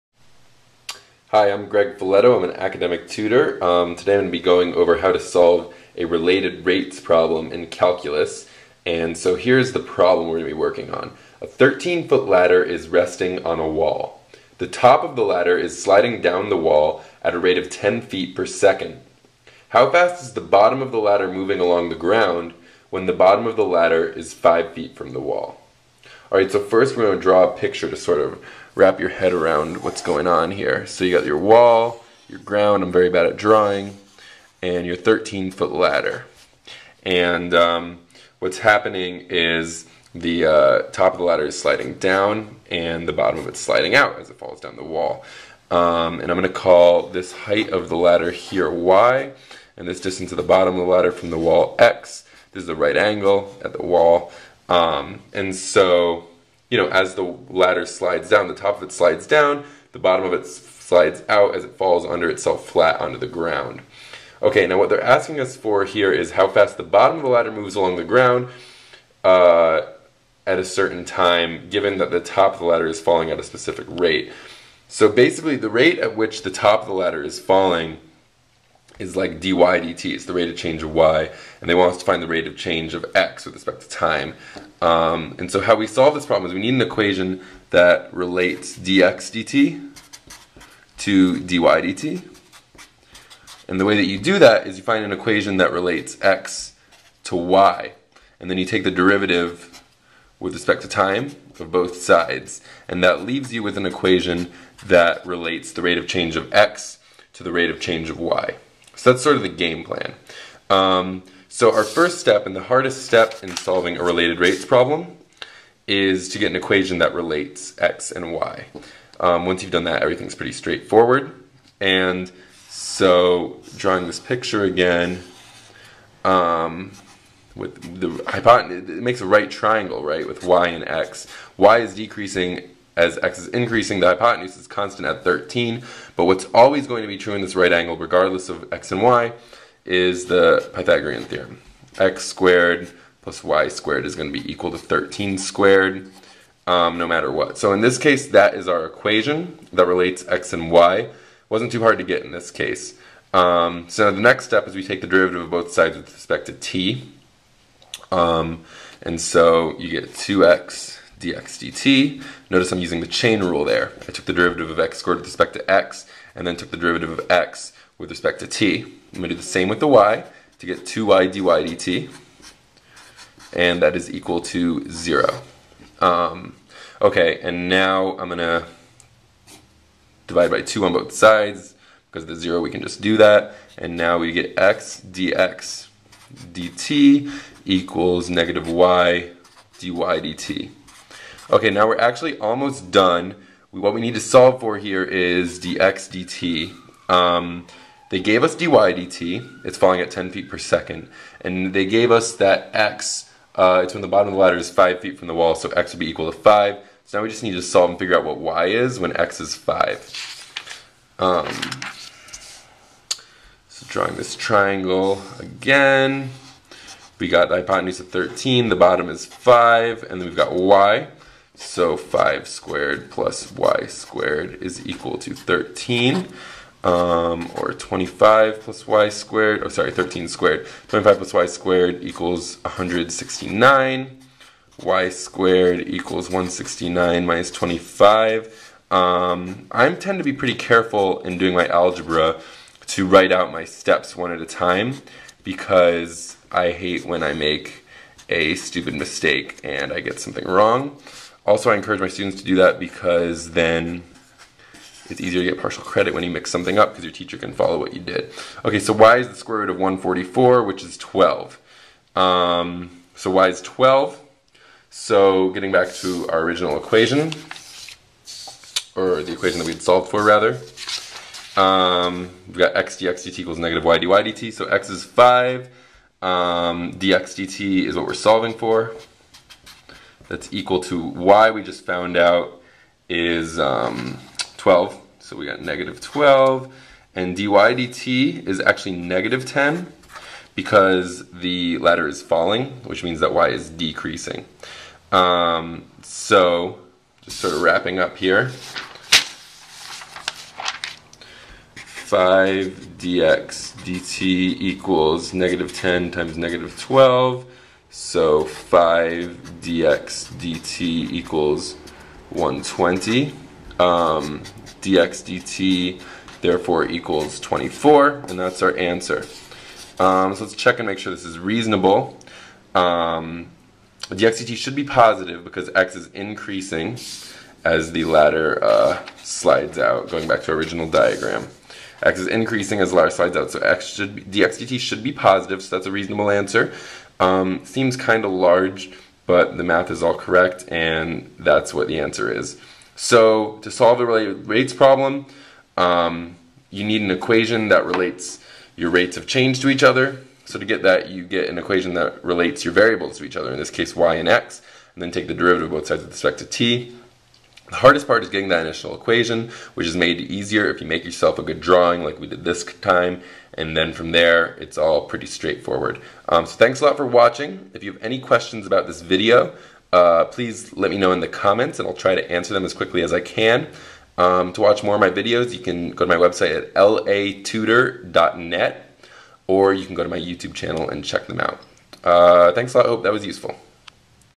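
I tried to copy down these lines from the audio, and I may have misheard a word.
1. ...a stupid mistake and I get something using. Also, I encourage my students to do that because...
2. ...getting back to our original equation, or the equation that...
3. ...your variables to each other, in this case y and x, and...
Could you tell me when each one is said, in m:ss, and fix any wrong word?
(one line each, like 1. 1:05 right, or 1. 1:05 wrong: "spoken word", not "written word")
1. 4:08 wrong: "wrong", not "using"
2. 4:25 right
3. 5:52 right.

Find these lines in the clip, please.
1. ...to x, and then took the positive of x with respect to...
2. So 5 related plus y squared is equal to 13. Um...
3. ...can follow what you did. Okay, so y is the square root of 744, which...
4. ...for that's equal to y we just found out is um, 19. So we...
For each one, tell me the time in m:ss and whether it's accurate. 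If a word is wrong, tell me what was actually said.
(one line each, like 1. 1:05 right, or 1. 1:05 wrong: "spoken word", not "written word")
1. 2:45 wrong: "derivative", not "positive"
2. 3:41 wrong: "squared", not "related"
3. 4:17 wrong: "144", not "744"
4. 4:38 wrong: "12", not "19".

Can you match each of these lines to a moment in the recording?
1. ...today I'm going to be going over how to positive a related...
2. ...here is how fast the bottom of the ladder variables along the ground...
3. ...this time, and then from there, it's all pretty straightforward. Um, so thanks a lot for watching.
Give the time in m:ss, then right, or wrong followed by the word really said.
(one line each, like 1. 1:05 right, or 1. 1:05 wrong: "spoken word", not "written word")
1. 0:03 wrong: "solve", not "positive"
2. 1:05 wrong: "moves", not "variables"
3. 6:02 right.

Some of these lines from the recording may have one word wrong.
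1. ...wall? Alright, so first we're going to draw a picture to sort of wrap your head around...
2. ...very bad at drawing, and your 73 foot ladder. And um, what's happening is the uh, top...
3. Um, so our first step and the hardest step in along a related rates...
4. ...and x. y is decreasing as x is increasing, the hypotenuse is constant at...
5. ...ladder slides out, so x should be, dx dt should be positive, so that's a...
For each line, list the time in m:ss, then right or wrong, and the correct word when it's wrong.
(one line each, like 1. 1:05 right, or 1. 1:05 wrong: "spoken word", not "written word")
1. 0:25 right
2. 0:32 wrong: "13", not "73"
3. 1:50 wrong: "solving", not "along"
4. 2:10 right
5. 5:32 right.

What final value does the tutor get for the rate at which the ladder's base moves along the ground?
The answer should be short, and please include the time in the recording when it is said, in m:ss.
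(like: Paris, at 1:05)
24, at 5:17.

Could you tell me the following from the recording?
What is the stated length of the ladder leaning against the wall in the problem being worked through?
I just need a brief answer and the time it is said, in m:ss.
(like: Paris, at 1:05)
13 feet, at 0:11.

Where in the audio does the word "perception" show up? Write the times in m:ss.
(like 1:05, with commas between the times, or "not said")
not said.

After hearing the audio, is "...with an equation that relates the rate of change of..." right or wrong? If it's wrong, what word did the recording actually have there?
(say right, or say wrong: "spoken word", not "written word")
right.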